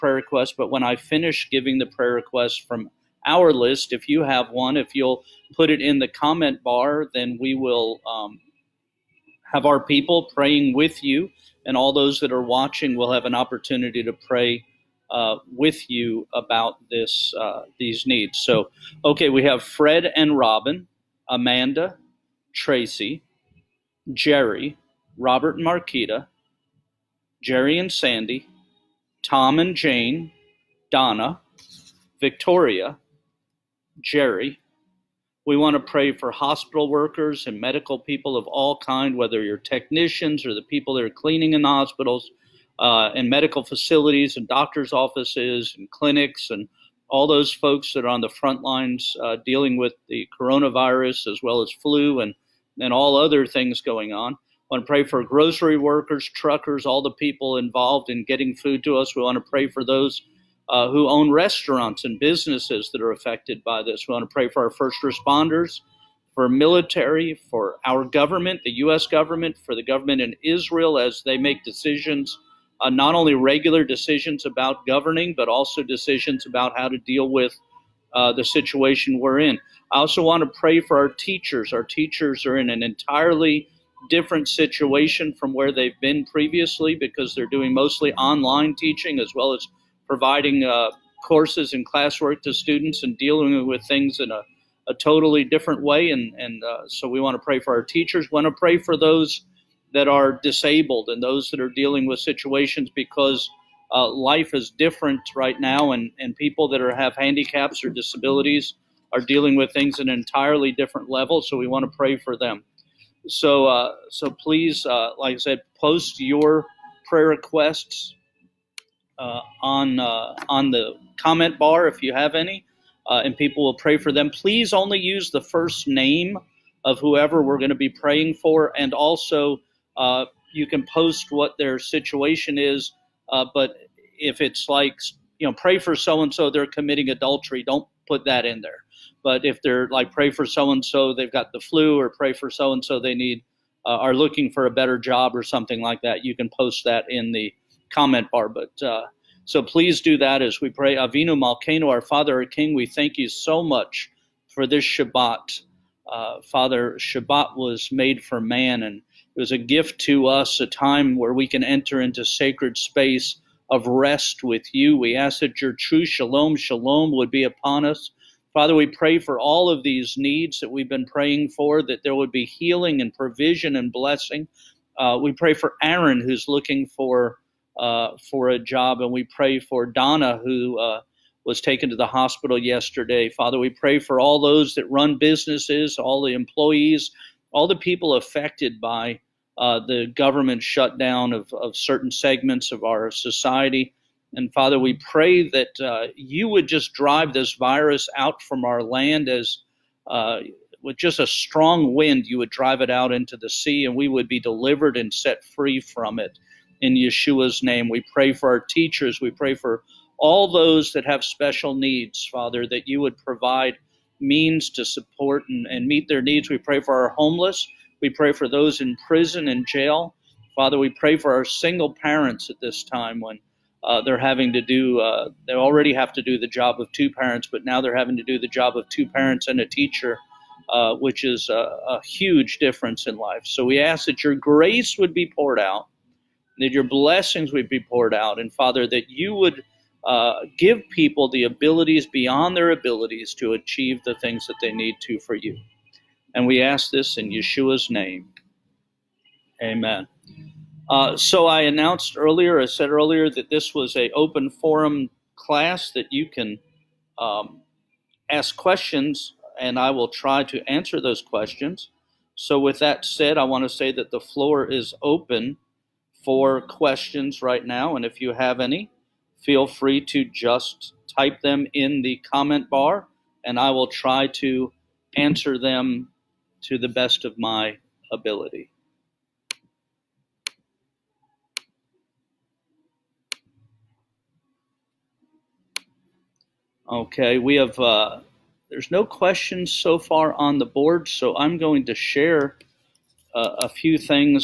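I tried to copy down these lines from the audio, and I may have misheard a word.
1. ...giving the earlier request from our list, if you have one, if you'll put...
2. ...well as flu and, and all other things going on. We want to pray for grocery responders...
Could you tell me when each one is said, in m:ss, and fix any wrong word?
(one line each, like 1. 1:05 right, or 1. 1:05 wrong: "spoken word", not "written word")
1. 0:01 wrong: "prayer", not "earlier"
2. 0:51 wrong: "workers", not "responders".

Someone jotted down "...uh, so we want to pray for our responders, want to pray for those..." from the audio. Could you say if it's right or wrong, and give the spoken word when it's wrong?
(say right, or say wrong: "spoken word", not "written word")
wrong: "teachers", not "responders".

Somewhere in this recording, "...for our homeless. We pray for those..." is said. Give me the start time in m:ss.
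3:36.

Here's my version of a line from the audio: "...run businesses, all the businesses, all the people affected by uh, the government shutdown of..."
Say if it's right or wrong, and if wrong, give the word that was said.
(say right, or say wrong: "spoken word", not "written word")
wrong: "employees", not "businesses".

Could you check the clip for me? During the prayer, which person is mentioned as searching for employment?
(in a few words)
Aaron.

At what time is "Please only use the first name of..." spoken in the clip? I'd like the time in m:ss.
2:04.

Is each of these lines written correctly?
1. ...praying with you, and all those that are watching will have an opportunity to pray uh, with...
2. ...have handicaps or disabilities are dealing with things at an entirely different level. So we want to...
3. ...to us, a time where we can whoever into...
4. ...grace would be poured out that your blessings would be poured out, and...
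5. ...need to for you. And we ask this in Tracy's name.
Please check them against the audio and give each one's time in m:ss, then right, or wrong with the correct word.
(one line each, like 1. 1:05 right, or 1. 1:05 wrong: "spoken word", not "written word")
1. 0:10 right
2. 1:46 right
3. 2:40 wrong: "enter", not "whoever"
4. 3:54 right
5. 4:04 wrong: "Yeshua", not "Tracy".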